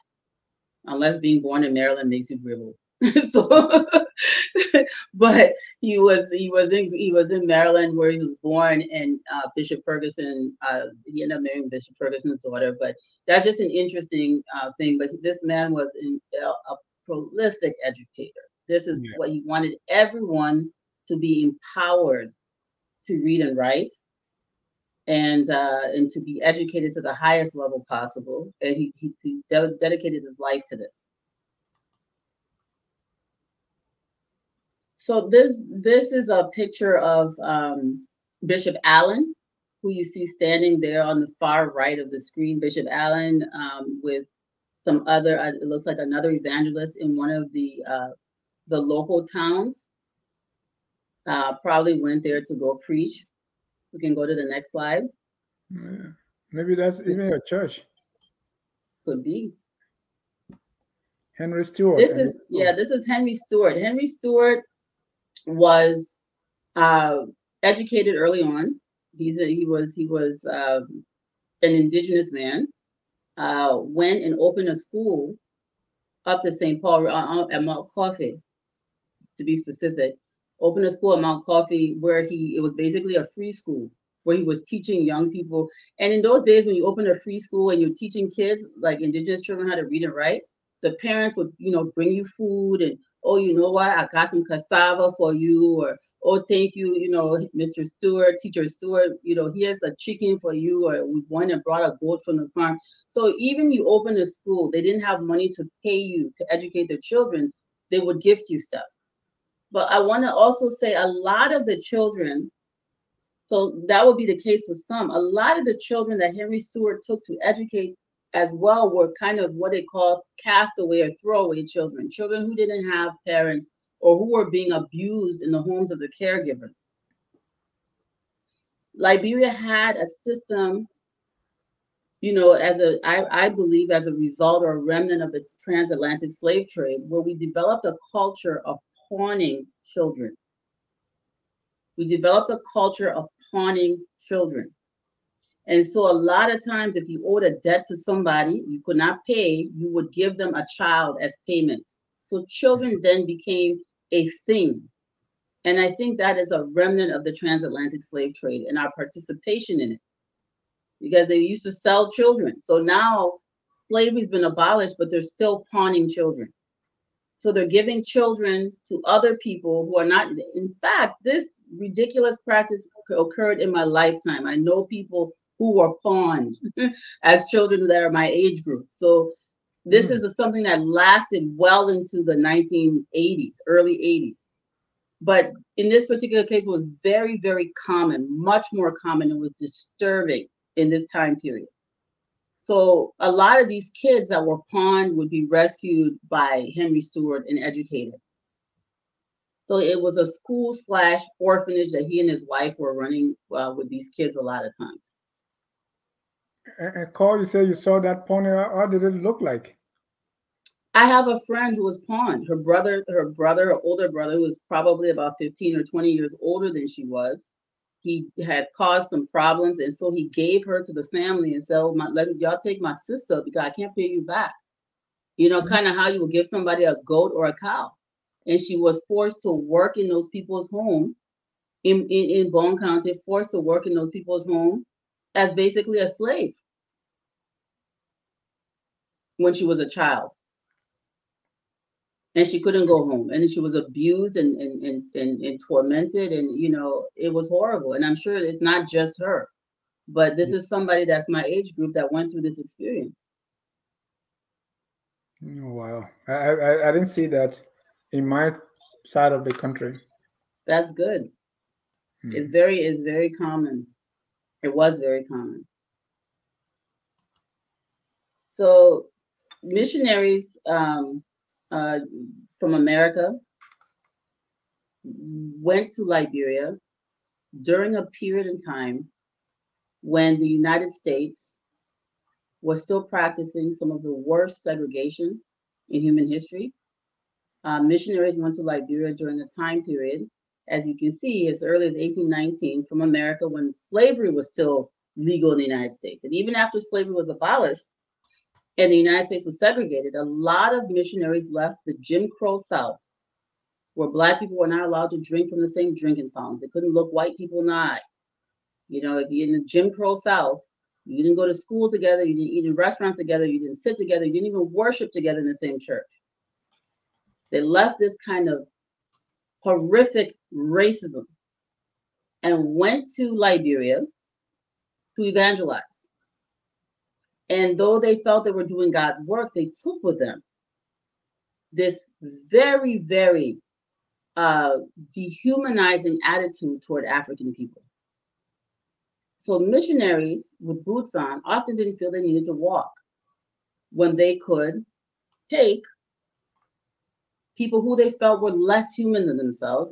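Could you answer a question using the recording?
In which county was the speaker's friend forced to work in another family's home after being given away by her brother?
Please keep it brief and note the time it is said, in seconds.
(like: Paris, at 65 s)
Bong County, at 232 s.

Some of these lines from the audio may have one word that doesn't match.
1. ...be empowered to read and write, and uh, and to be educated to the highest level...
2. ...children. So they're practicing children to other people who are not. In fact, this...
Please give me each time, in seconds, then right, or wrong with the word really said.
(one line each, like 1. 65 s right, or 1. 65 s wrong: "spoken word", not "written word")
1. 21 s right
2. 166 s wrong: "giving", not "practicing".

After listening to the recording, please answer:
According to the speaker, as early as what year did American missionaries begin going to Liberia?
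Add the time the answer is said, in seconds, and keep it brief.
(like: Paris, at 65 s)
1819, at 291 s.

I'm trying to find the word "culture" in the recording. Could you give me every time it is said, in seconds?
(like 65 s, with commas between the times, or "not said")
138 s, 142 s.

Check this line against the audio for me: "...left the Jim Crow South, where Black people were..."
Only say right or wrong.
right.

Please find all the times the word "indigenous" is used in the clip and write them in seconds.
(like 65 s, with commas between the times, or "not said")
71 s, 89 s.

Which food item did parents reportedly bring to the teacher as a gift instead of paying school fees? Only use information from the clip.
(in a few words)
cassava.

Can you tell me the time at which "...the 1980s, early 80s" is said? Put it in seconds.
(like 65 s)
182 s.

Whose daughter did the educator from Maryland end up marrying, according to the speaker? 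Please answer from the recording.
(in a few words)
Bishop Ferguson's daughter.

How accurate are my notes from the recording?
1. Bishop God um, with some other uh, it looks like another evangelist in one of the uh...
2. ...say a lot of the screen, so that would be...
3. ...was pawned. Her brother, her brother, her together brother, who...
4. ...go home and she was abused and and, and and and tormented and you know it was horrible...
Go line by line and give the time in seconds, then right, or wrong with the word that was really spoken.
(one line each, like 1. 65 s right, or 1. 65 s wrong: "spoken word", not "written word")
1. 42 s wrong: "Allen", not "God"
2. 110 s wrong: "children", not "screen"
3. 211 s wrong: "older", not "together"
4. 242 s right.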